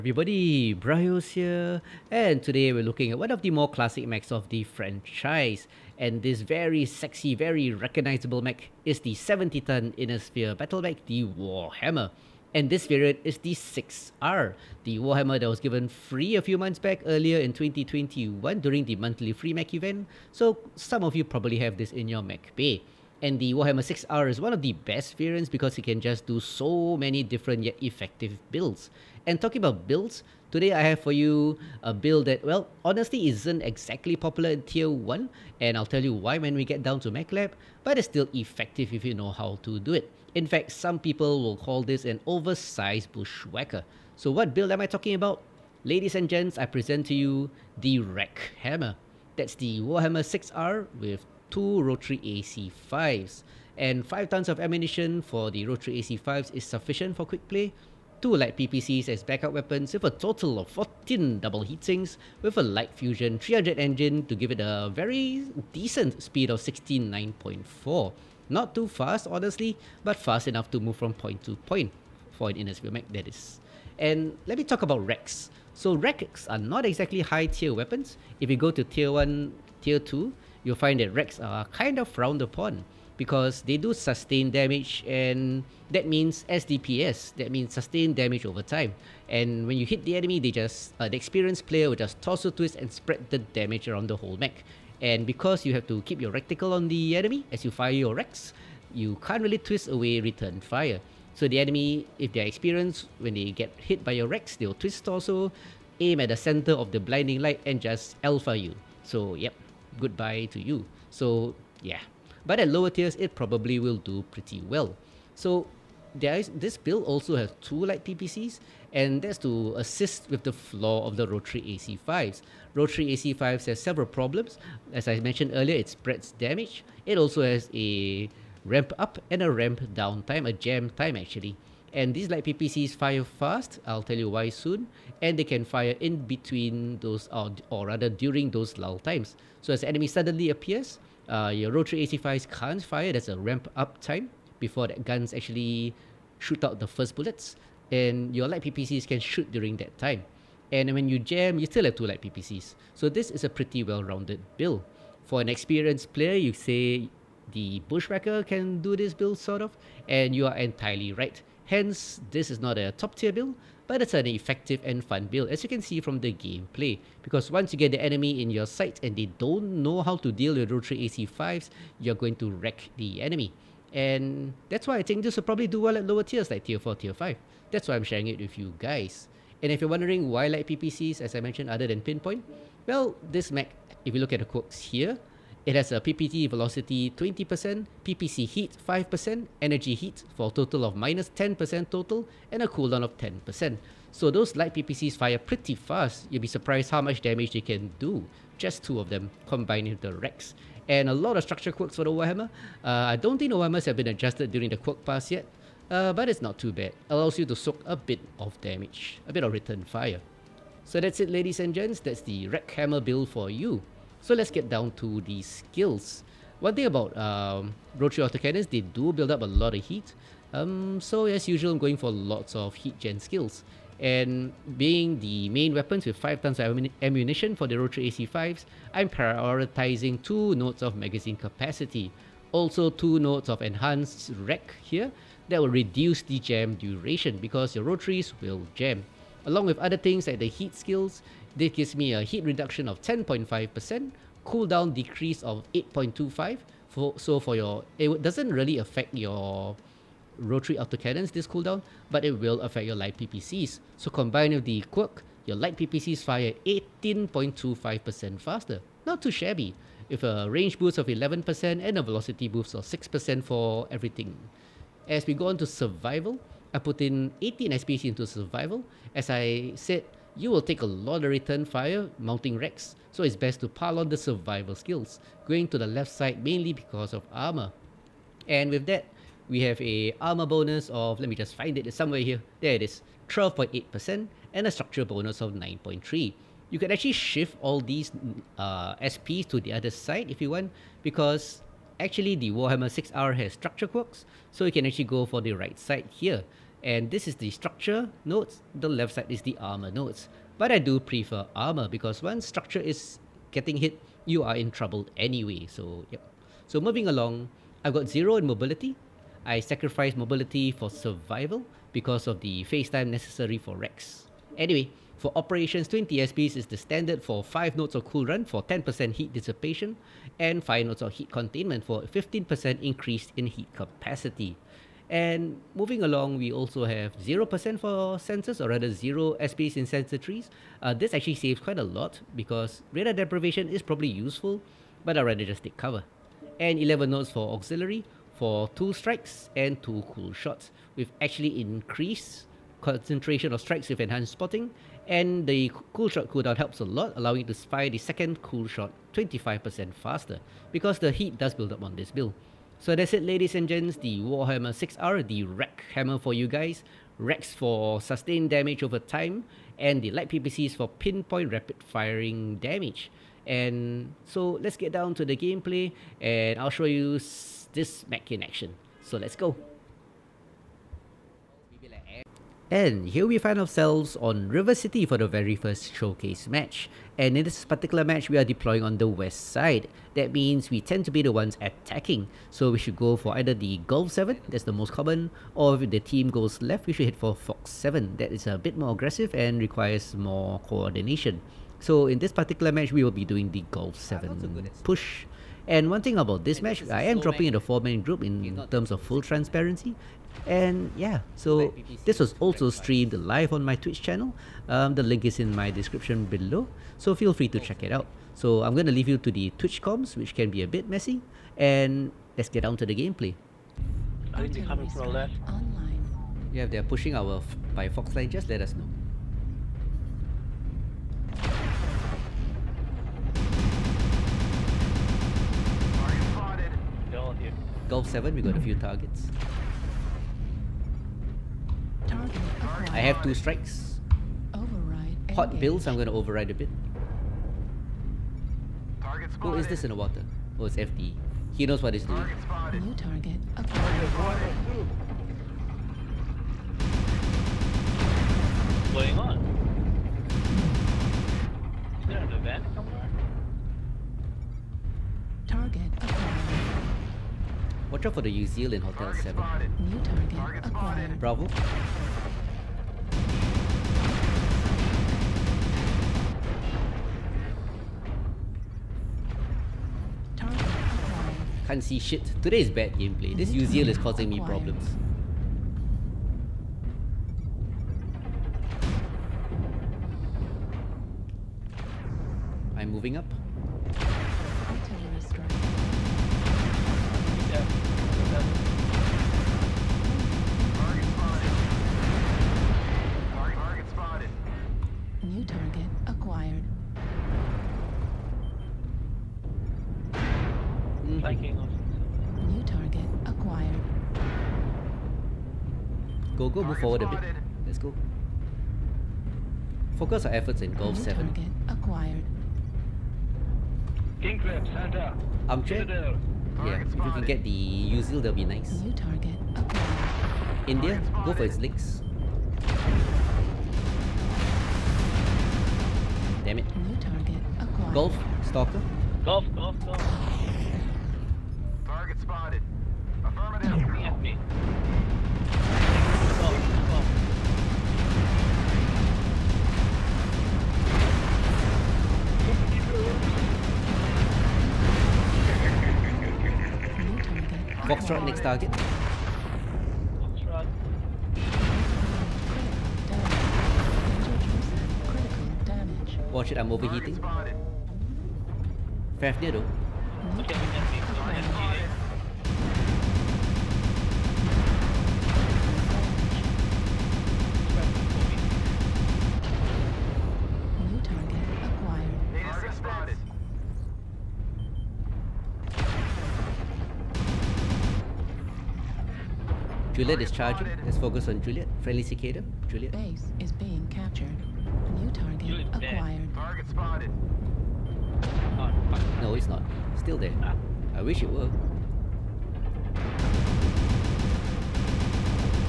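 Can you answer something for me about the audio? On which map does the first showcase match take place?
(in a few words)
River City.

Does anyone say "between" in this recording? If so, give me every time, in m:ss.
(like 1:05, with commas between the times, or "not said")
2:16.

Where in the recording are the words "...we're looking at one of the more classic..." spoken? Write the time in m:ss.
0:02.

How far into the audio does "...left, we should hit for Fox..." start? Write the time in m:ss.
6:26.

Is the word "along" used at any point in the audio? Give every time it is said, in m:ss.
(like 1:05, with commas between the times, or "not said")
3:59, 5:07, 5:26.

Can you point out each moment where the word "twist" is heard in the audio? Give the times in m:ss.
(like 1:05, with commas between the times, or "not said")
1:32, 1:39, 1:44.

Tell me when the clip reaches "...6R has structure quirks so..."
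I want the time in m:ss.
4:52.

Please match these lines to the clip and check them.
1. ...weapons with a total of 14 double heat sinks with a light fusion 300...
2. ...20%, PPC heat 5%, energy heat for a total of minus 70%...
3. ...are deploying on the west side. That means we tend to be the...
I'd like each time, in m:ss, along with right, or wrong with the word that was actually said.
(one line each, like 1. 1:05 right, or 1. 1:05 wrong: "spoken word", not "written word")
1. 0:59 right
2. 3:07 wrong: "10", not "70"
3. 6:18 right.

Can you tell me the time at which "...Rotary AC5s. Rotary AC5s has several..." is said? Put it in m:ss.
2:01.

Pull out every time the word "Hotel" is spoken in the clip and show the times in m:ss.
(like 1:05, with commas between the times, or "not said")
7:38.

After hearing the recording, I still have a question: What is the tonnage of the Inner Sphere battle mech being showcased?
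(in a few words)
70 ton.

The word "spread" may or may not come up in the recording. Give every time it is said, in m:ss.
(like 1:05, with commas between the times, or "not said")
1:32, 2:05.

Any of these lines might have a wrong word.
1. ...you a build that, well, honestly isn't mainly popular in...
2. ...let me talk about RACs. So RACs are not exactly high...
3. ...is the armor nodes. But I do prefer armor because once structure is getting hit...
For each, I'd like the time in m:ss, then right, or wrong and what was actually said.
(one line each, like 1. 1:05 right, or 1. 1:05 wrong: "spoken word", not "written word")
1. 0:31 wrong: "exactly", not "mainly"
2. 1:14 right
3. 4:59 right.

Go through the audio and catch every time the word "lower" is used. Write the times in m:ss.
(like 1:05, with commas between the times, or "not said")
1:52, 2:56.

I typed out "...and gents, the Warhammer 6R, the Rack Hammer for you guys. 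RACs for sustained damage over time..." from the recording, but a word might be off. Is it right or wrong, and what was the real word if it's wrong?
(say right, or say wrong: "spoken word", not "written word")
right.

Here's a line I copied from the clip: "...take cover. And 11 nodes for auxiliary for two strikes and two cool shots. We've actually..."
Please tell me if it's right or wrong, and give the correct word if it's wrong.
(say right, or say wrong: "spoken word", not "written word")
right.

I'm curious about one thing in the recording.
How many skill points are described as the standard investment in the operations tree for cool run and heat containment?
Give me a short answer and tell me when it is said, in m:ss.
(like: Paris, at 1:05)
20, at 5:15.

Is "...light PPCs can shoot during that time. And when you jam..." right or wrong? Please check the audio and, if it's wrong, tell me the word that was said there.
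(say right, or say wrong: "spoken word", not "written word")
right.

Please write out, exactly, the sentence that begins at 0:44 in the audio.
So what build am I talking about?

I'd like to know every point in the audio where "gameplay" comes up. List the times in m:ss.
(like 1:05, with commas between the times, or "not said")
2:46, 6:05, 6:52, 7:52.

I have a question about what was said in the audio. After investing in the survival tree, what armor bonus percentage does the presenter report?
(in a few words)
12.8%.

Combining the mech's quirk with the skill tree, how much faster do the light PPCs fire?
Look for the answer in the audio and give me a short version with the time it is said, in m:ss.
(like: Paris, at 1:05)
18.25%, at 4:16.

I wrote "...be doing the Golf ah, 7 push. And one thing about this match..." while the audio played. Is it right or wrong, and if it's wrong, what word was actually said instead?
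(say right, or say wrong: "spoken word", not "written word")
right.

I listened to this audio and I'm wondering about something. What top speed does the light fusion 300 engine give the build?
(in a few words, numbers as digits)
169.4.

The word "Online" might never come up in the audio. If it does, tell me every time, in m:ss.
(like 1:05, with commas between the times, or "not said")
6:55.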